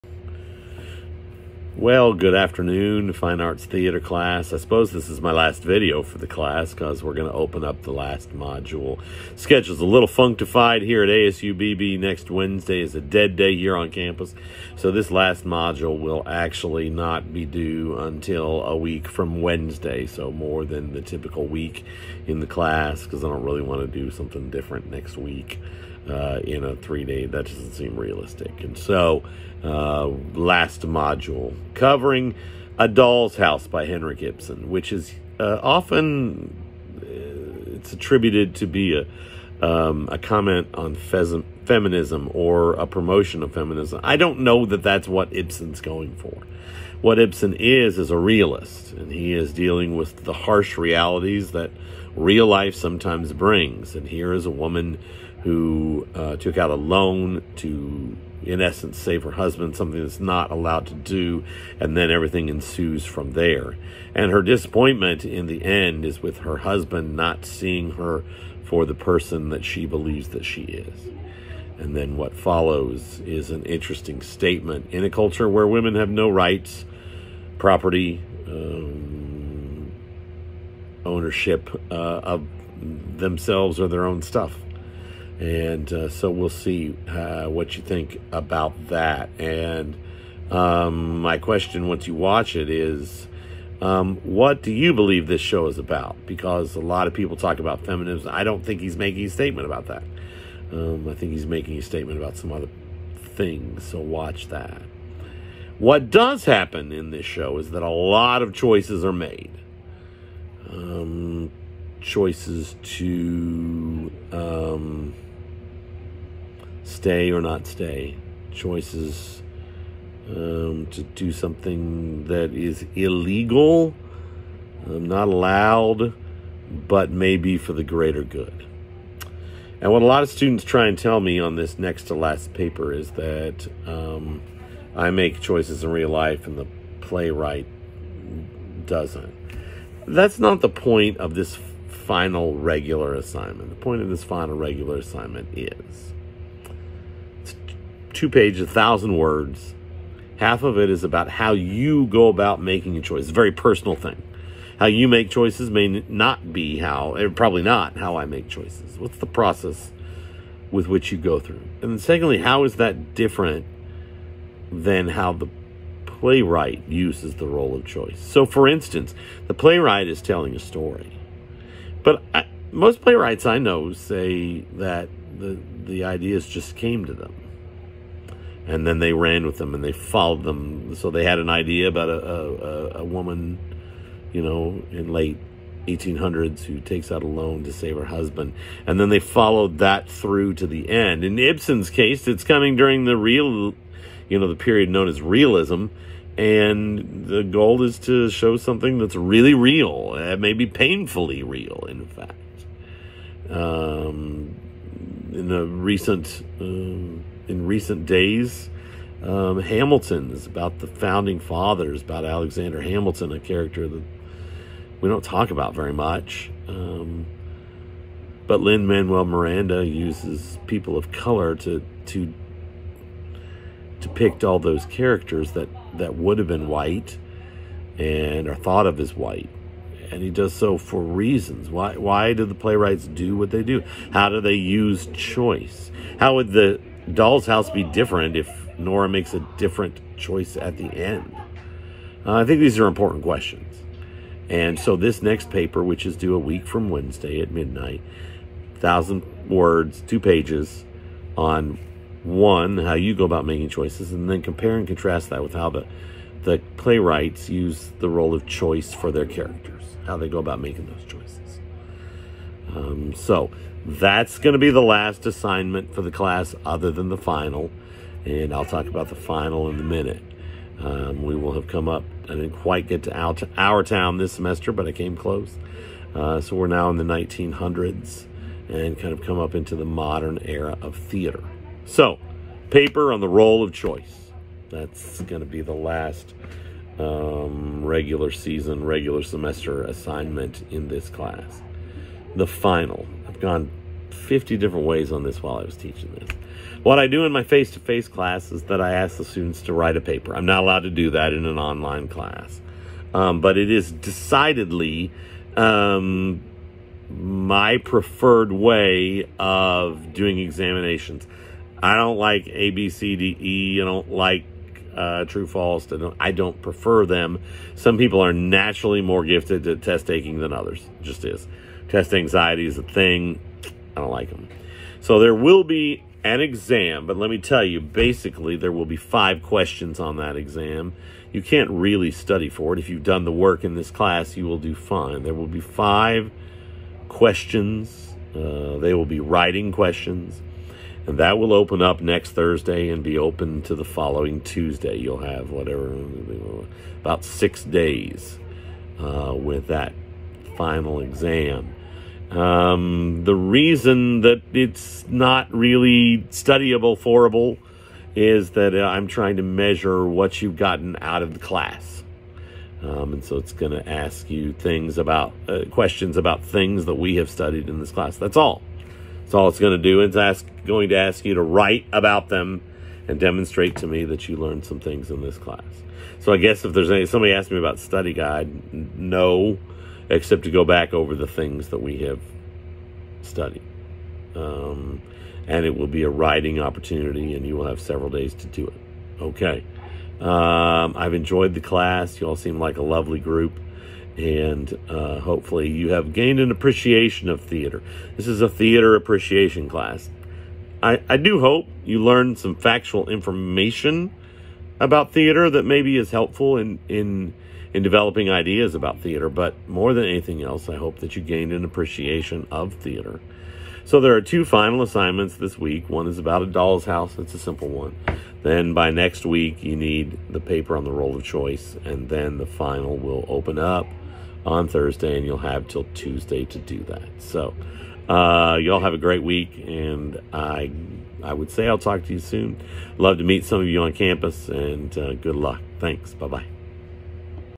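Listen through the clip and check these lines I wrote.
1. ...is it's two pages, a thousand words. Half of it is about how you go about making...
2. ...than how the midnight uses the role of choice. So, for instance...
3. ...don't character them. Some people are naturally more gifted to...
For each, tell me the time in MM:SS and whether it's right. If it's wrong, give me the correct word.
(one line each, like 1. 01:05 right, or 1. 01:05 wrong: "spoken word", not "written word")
1. 02:25 right
2. 02:44 wrong: "playwright", not "midnight"
3. 05:16 wrong: "prefer", not "character".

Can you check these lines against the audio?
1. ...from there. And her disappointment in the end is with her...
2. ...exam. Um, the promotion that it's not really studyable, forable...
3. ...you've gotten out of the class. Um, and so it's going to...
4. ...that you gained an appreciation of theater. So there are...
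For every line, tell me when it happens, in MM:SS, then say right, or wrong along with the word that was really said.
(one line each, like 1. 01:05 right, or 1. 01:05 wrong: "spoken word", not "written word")
1. 01:03 right
2. 05:50 wrong: "reason", not "promotion"
3. 06:00 right
4. 06:50 right.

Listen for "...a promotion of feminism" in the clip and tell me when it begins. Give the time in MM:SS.
00:42.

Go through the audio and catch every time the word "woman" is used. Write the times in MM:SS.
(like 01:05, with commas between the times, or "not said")
00:54, 03:03.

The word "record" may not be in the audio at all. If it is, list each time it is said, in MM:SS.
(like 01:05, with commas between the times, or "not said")
not said.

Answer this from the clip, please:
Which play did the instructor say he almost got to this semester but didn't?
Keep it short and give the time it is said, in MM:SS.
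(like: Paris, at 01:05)
Our Town, at 04:33.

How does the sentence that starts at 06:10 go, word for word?
It's ask, going to ask you to write about them and demonstrate to me that you learned some things in this class.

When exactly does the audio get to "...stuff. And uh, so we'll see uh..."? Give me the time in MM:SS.
01:24.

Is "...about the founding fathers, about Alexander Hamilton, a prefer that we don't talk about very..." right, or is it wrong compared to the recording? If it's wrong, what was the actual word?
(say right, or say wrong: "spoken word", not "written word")
wrong: "character", not "prefer".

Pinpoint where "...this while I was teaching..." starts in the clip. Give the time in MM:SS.
04:55.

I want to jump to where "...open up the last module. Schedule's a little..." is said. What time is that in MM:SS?
00:07.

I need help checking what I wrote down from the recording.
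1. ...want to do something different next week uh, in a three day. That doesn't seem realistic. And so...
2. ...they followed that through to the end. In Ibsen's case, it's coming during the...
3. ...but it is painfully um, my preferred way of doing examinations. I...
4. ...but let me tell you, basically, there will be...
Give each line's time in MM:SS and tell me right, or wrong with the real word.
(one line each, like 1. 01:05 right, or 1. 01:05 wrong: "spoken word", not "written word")
1. 00:23 right
2. 03:09 right
3. 05:03 wrong: "decidedly", not "painfully"
4. 05:27 right.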